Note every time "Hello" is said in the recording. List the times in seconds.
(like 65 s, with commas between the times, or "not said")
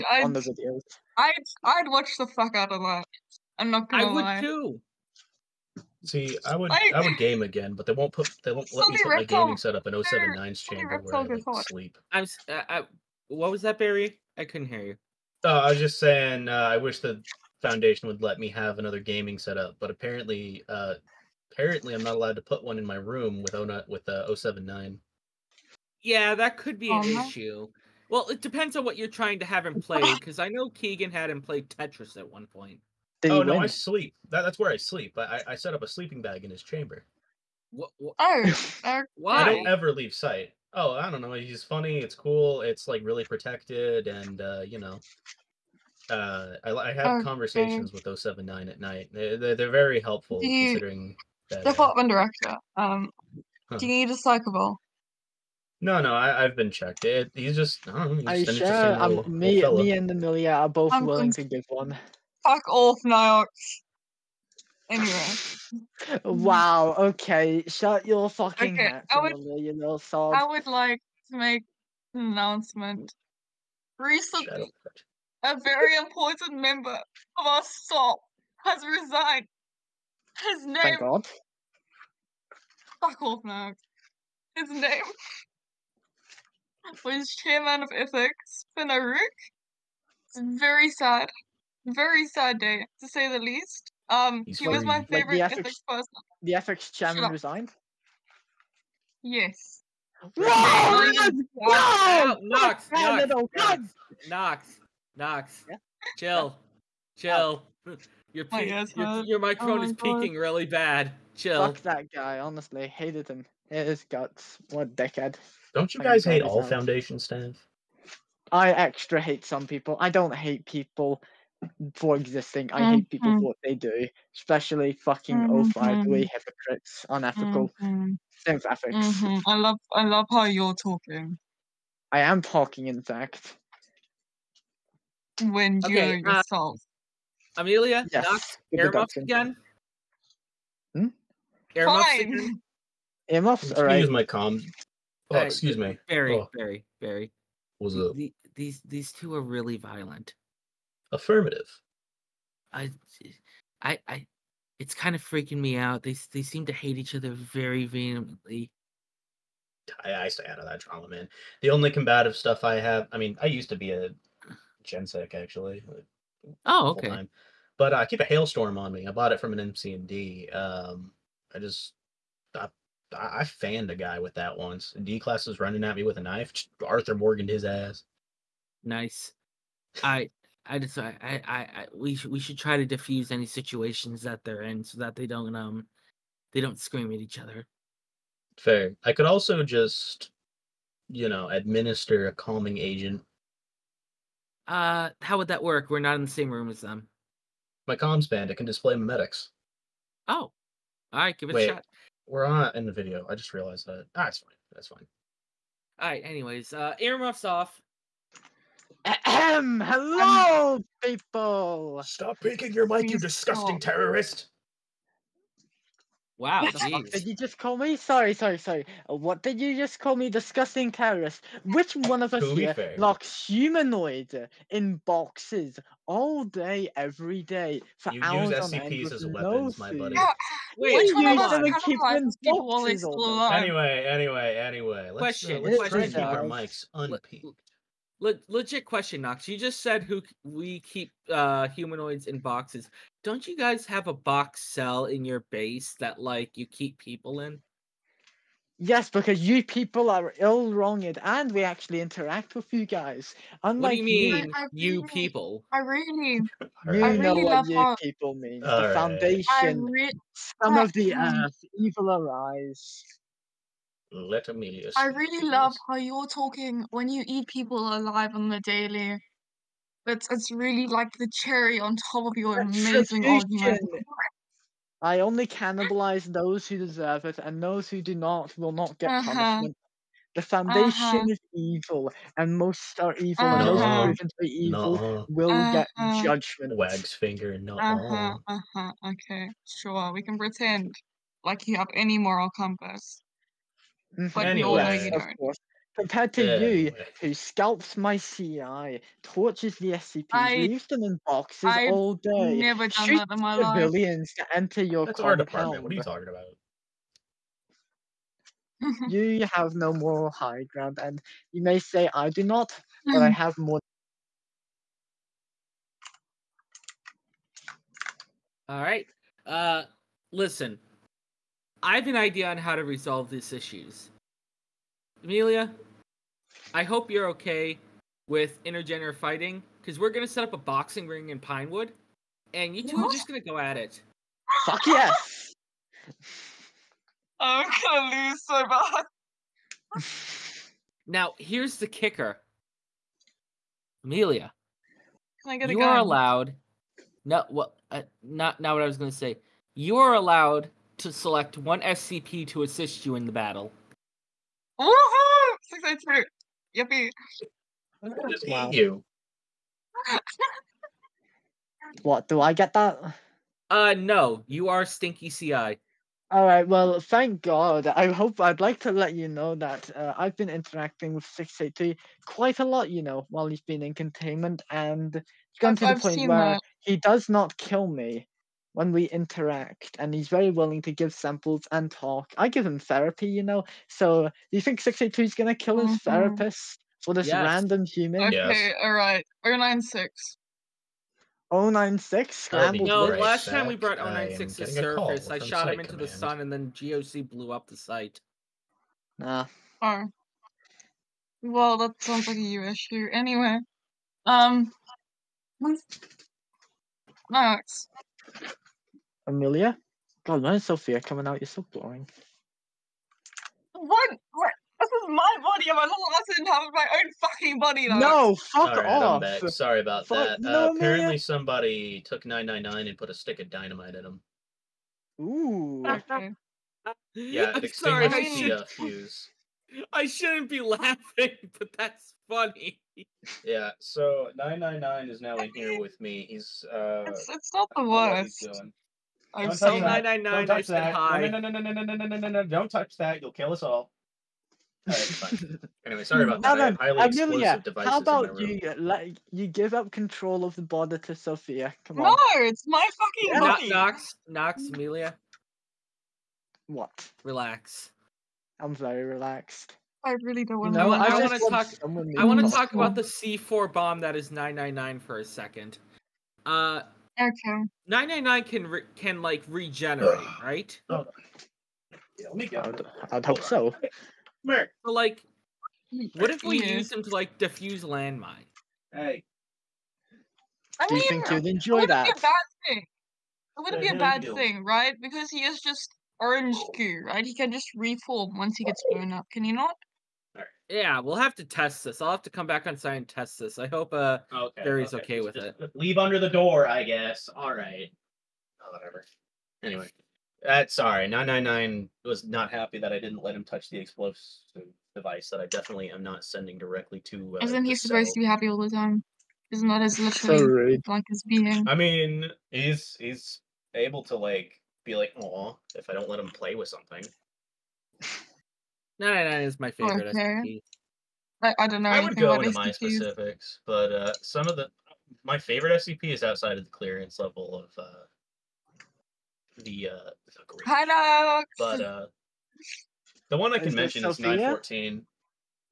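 209 s, 530 s.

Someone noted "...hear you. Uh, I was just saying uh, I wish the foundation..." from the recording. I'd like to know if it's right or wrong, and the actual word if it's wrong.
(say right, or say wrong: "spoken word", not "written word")
right.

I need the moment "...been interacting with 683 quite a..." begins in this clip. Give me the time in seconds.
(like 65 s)
370 s.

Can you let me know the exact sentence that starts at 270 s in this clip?
It's it's really like the cherry on top of your amazing argument.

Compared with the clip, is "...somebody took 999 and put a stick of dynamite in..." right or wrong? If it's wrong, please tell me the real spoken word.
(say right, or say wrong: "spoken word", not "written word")
right.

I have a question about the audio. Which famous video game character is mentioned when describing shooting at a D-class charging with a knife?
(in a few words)
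Arthur Morgan.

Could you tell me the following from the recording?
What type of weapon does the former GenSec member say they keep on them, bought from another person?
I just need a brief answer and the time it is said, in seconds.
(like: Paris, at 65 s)
Hailstorm, at 168 s.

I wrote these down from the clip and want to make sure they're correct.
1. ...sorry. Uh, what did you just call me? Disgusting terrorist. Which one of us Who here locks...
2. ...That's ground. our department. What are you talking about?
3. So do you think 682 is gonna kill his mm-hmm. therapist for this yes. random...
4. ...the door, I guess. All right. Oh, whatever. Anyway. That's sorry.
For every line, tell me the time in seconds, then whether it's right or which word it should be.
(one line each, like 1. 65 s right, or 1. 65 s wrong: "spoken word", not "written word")
1. 218 s right
2. 305 s wrong: "compound", not "ground"
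3. 383 s right
4. 496 s right.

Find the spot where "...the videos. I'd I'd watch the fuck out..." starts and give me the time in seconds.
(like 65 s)
0 s.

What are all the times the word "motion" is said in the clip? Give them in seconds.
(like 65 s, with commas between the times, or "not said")
not said.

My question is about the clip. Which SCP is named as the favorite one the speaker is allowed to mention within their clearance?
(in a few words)
914.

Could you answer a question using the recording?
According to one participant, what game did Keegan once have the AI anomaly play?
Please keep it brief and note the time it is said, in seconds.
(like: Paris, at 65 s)
Tetris, at 31 s.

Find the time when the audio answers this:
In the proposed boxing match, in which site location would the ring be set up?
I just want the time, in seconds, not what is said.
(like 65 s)
331 s.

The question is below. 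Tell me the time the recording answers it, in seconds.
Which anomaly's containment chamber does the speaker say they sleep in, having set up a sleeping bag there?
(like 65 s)
9 s.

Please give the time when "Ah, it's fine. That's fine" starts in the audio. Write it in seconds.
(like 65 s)
204 s.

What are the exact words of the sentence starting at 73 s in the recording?
Recently, a very important member of our staff has resigned.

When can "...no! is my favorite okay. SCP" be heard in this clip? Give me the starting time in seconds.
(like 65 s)
518 s.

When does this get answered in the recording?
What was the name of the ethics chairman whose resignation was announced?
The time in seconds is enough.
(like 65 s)
88 s.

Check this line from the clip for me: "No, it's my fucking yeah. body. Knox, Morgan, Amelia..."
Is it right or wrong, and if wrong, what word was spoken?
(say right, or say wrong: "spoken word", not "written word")
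wrong: "Knox", not "Morgan".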